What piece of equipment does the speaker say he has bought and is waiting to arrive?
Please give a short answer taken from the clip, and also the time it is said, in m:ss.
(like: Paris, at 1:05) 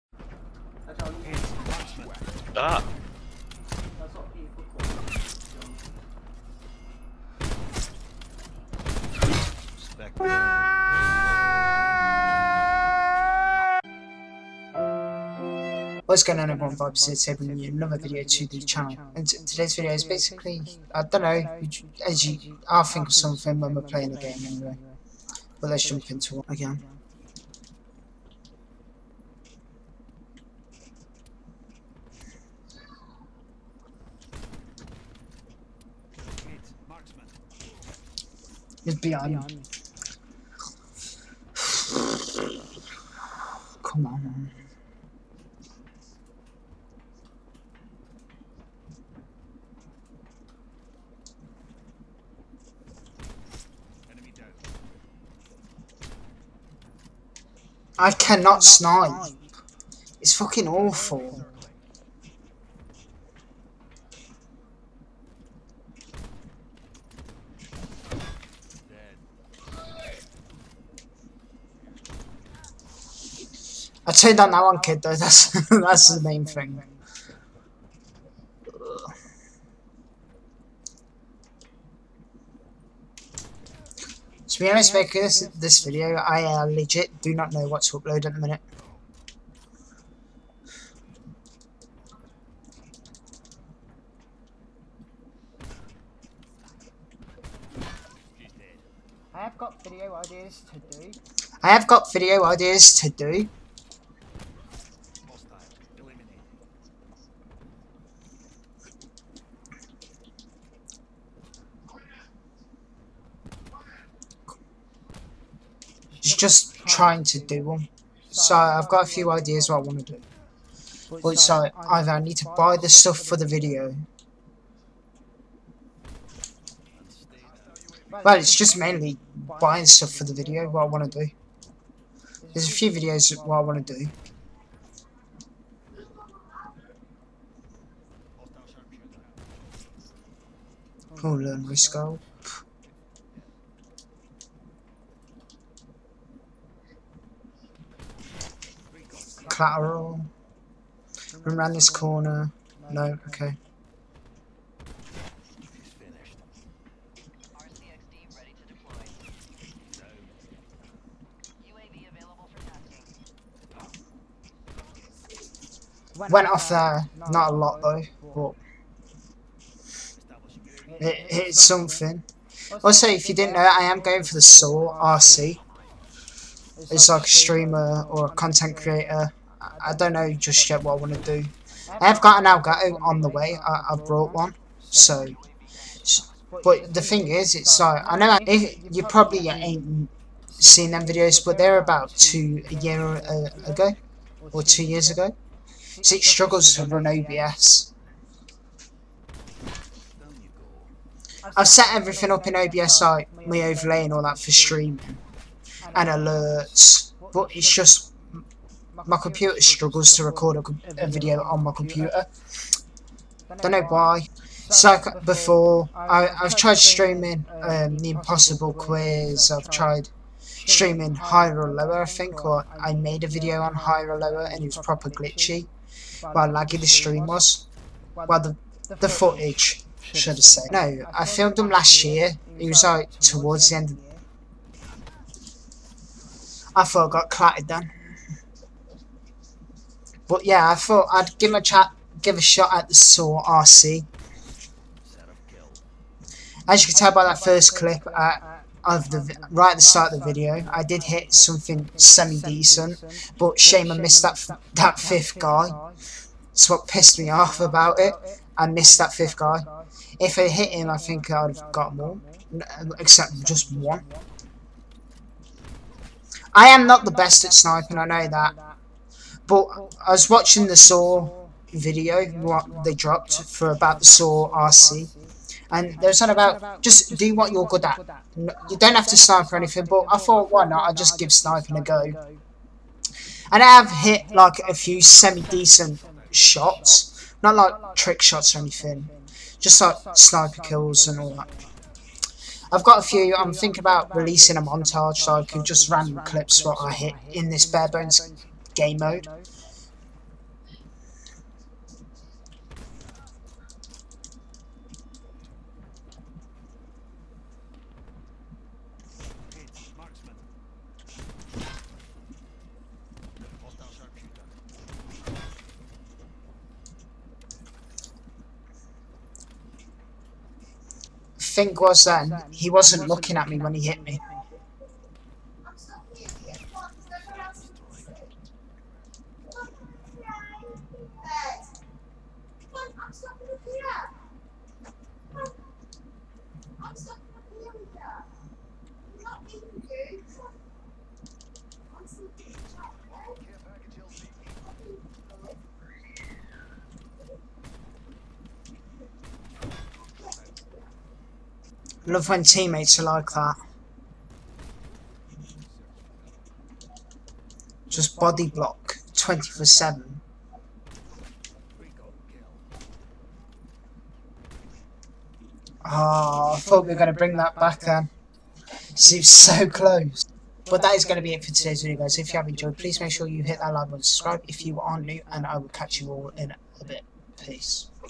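Elgato, at 3:02.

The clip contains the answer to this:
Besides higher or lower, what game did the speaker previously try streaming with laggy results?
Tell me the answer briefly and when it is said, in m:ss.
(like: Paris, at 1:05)
The Impossible Quiz, at 3:37.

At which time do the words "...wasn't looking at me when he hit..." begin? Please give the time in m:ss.
5:22.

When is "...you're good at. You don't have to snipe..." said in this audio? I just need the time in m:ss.
4:37.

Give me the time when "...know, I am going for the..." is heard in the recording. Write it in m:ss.
2:53.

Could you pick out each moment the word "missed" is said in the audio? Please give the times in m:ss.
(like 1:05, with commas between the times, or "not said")
4:13, 4:18.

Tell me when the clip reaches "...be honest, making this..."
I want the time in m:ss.
1:24.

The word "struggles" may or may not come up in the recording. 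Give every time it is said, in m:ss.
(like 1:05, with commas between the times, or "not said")
3:16, 3:29.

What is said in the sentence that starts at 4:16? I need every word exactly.
That's what pissed me off about it.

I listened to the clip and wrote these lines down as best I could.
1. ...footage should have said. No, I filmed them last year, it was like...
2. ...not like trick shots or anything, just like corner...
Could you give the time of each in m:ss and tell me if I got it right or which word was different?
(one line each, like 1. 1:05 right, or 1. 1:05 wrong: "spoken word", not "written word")
1. 3:49 right
2. 4:47 wrong: "sniper", not "corner".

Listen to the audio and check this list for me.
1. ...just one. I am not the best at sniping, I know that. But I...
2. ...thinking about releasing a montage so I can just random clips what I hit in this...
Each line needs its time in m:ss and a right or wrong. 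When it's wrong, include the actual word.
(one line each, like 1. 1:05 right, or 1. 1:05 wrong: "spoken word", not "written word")
1. 4:23 right
2. 4:53 right.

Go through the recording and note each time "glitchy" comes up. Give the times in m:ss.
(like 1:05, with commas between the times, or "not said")
3:45.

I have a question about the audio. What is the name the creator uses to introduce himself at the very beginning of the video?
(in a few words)
Vibes.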